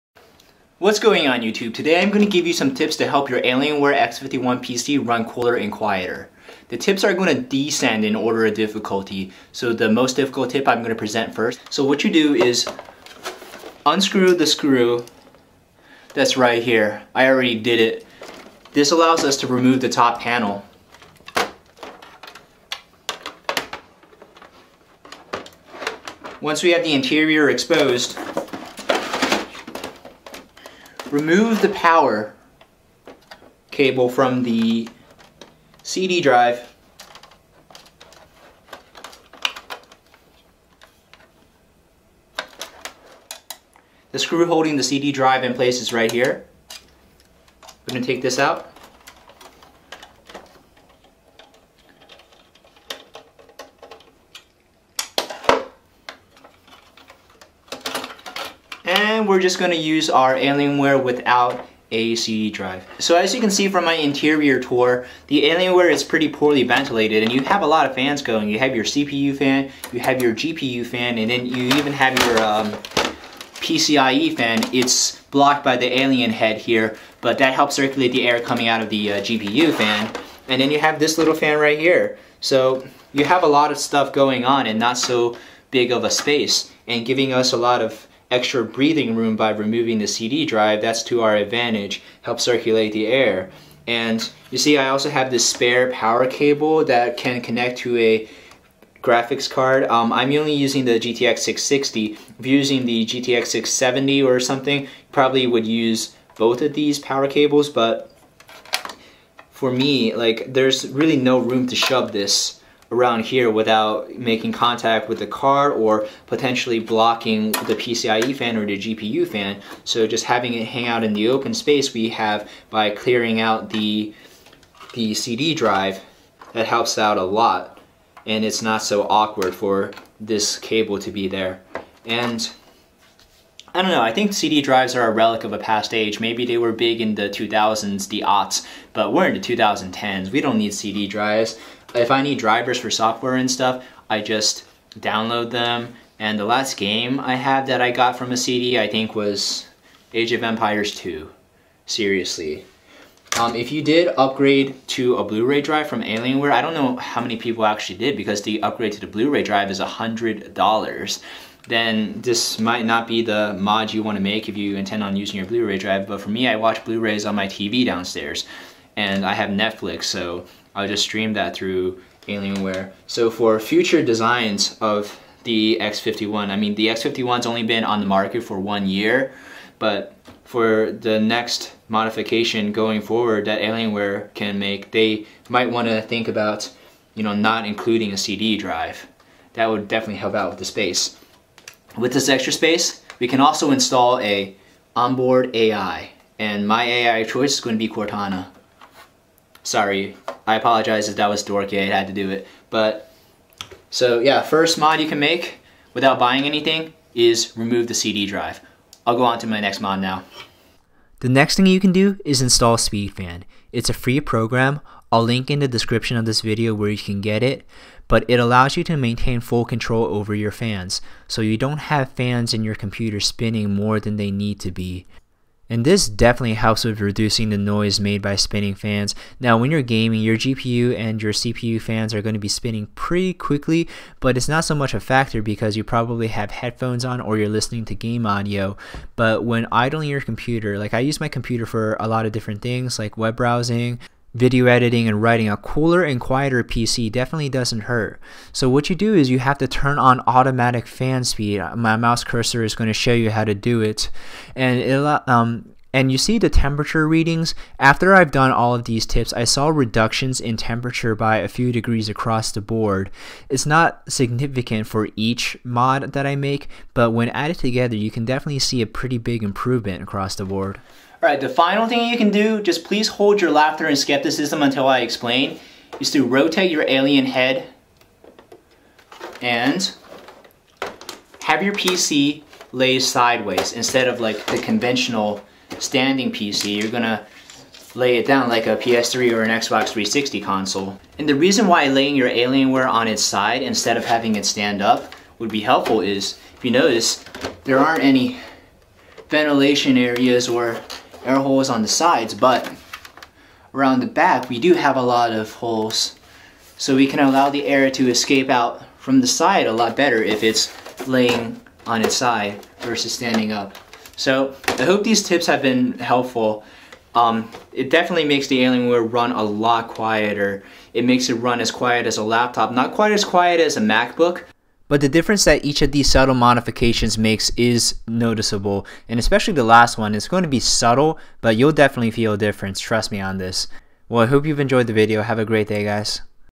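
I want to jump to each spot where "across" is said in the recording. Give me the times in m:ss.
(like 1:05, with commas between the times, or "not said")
4:22, 4:30.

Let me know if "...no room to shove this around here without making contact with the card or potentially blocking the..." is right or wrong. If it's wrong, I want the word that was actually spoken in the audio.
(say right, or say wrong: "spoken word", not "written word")
right.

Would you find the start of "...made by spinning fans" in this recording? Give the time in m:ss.
3:47.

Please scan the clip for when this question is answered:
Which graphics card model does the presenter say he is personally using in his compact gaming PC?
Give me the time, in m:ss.
1:40.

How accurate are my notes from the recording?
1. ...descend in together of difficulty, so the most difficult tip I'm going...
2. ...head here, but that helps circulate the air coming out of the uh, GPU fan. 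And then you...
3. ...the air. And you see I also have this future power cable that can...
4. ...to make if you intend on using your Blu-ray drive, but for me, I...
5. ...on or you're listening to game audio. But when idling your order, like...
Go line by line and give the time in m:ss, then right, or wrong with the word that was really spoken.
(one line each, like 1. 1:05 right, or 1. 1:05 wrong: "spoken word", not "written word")
1. 0:07 wrong: "order", not "together"
2. 1:16 right
3. 1:32 wrong: "spare", not "future"
4. 2:44 right
5. 3:57 wrong: "computer", not "order".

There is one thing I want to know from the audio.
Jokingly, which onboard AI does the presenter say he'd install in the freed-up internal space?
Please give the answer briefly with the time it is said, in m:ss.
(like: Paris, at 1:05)
Cortana, at 3:17.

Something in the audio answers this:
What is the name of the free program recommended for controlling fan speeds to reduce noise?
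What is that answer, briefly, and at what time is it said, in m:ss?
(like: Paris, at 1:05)
SpeedFan, at 3:32.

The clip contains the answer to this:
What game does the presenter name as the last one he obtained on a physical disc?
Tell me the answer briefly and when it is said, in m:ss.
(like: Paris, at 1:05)
Age of Empires 2, at 2:30.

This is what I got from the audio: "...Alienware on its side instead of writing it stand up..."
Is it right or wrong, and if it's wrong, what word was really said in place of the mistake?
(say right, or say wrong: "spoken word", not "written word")
wrong: "having", not "writing".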